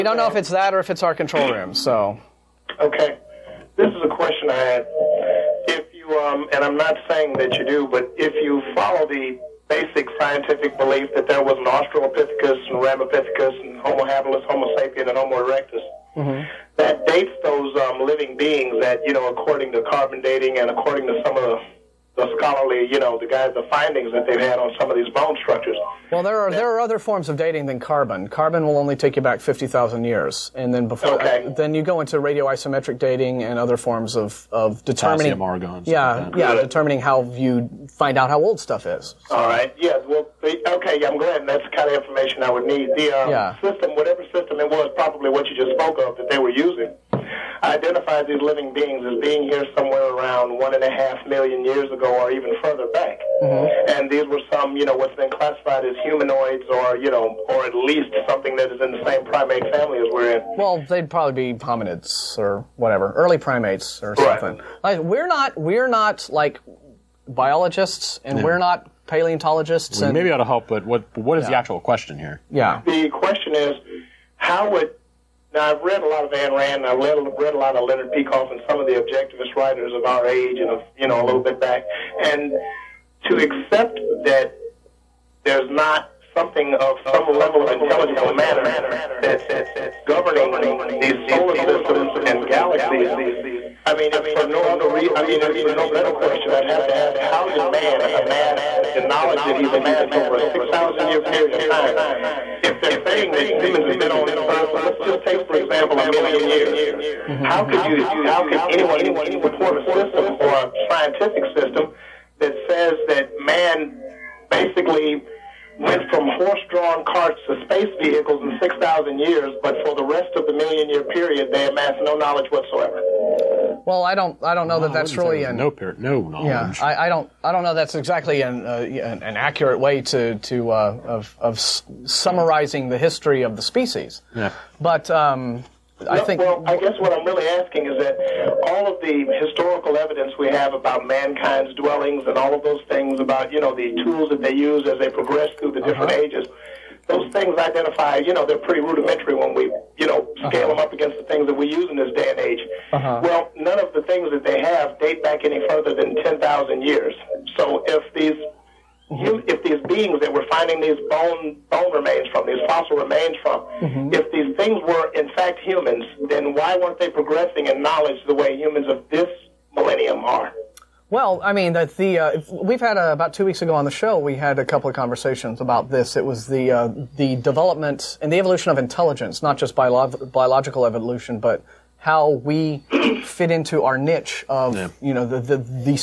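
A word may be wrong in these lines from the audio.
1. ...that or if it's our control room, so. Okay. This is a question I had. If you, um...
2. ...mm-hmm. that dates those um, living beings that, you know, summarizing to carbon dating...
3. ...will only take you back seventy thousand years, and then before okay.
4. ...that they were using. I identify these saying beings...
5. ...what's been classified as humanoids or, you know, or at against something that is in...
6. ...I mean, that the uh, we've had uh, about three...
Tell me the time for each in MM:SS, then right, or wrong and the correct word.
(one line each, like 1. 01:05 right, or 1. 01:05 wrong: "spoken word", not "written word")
1. 00:00 right
2. 00:16 wrong: "according", not "summarizing"
3. 00:28 wrong: "fifty", not "seventy"
4. 00:46 wrong: "living", not "saying"
5. 00:54 wrong: "least", not "against"
6. 02:51 wrong: "two", not "three".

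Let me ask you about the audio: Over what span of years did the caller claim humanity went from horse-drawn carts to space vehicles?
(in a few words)
6,000 years.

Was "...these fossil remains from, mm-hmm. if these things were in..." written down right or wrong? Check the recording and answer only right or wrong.
right.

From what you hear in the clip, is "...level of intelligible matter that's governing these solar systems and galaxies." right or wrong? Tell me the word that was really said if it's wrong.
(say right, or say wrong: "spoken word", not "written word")
right.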